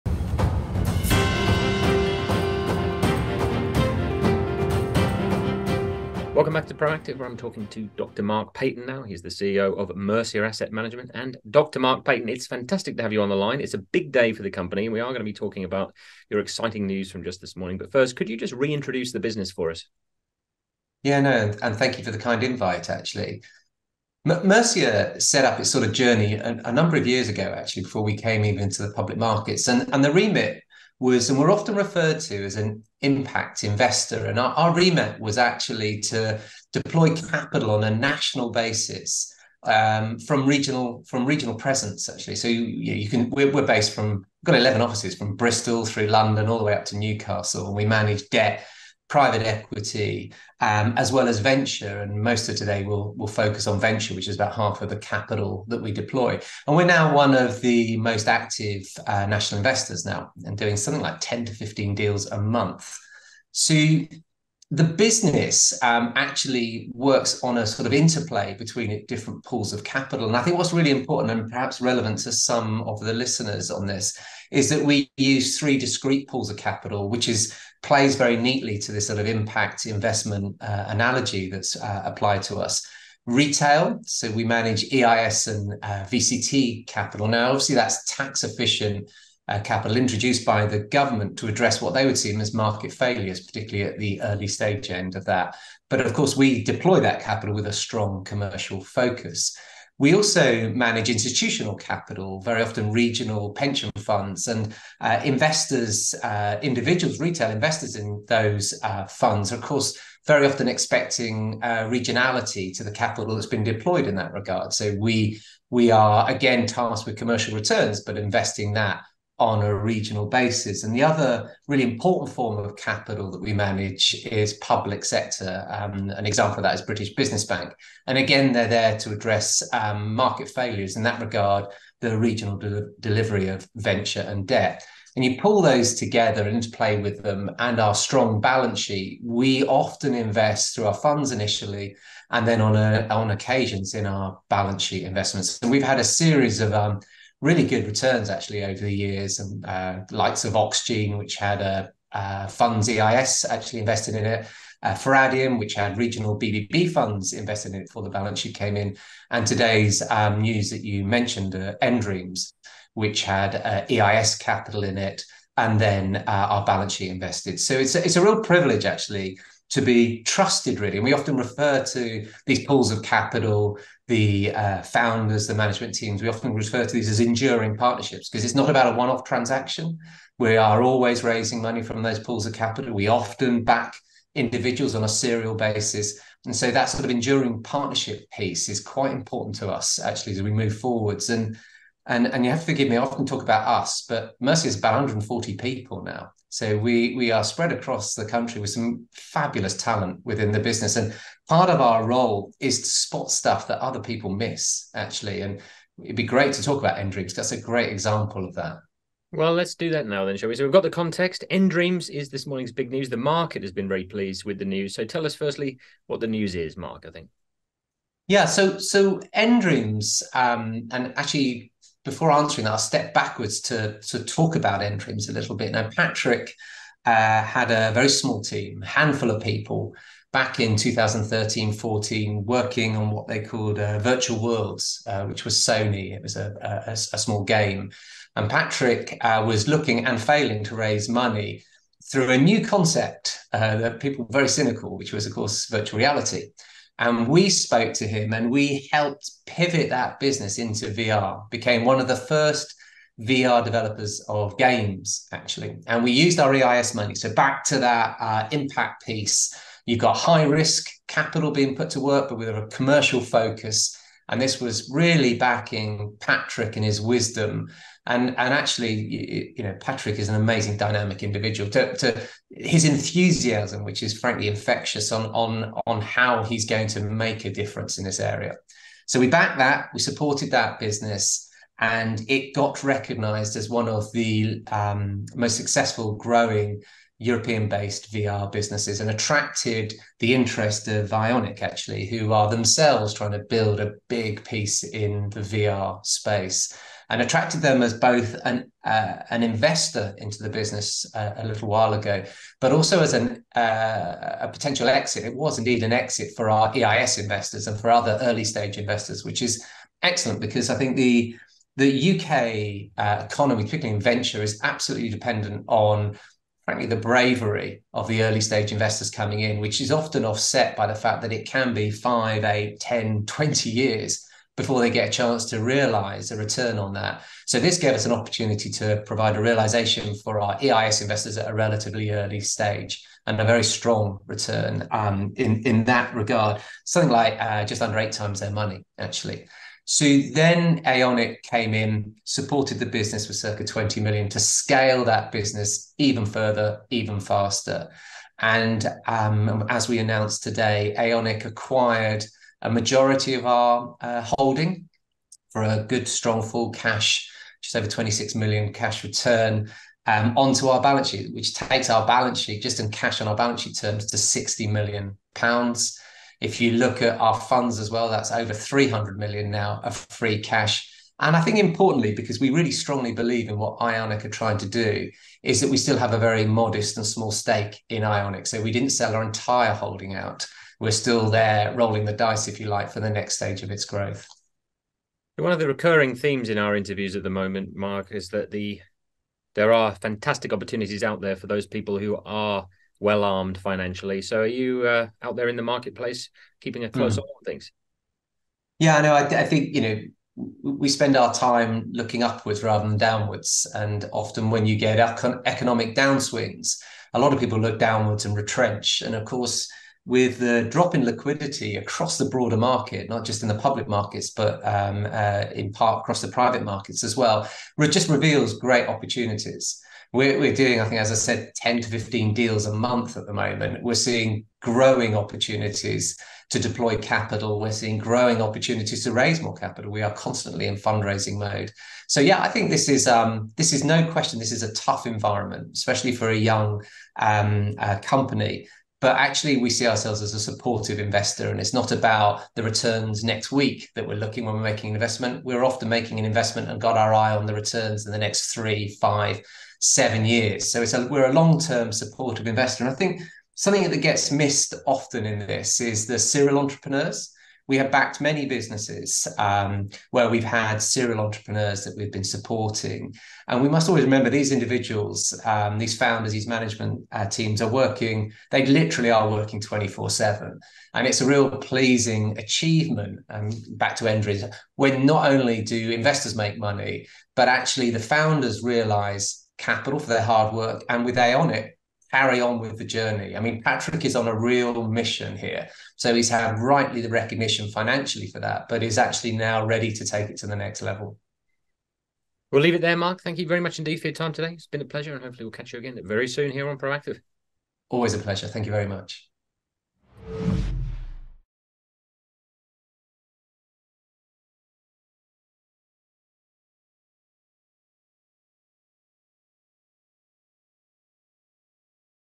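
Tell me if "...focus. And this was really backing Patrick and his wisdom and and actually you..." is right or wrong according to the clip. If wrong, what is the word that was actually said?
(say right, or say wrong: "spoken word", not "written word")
right.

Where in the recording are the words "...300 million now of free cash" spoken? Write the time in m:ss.
6:08.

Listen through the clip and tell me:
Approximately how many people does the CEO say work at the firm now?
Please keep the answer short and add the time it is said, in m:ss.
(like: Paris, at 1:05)
140, at 3:14.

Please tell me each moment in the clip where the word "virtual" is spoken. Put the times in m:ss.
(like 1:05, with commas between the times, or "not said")
3:53, 4:05.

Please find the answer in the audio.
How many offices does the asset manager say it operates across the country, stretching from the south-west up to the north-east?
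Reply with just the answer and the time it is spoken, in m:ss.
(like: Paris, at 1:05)
11, at 0:44.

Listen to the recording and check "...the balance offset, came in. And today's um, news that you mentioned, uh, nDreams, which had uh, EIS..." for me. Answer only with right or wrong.
wrong.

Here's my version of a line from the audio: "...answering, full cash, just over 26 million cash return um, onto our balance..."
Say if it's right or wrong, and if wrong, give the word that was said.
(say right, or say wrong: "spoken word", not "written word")
wrong: "strong", not "answering".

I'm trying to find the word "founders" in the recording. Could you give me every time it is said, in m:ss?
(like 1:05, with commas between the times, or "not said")
2:54, 7:45, 7:57.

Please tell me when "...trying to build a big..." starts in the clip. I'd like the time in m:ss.
4:53.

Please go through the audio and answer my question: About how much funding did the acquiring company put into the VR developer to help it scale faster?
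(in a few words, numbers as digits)
circa 20 million.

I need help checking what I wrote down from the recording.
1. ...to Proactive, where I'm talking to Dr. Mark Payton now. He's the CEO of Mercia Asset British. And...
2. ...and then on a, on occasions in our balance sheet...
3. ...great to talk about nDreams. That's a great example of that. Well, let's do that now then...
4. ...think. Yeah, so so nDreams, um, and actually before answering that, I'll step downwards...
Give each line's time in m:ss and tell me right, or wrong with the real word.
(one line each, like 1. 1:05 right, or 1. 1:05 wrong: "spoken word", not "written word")
1. 0:06 wrong: "Management", not "British"
2. 2:22 right
3. 3:26 right
4. 3:37 wrong: "backwards", not "downwards".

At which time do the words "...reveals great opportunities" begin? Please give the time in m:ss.
6:58.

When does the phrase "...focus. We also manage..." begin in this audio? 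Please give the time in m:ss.
1:38.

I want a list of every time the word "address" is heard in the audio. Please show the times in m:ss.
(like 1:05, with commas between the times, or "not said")
1:31, 2:09.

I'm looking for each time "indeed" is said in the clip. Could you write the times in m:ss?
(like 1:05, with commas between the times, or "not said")
5:05, 8:13.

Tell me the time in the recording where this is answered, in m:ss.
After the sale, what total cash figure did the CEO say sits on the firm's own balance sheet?
6:04.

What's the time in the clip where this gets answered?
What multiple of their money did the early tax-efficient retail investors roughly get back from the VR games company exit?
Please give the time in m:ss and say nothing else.
5:37.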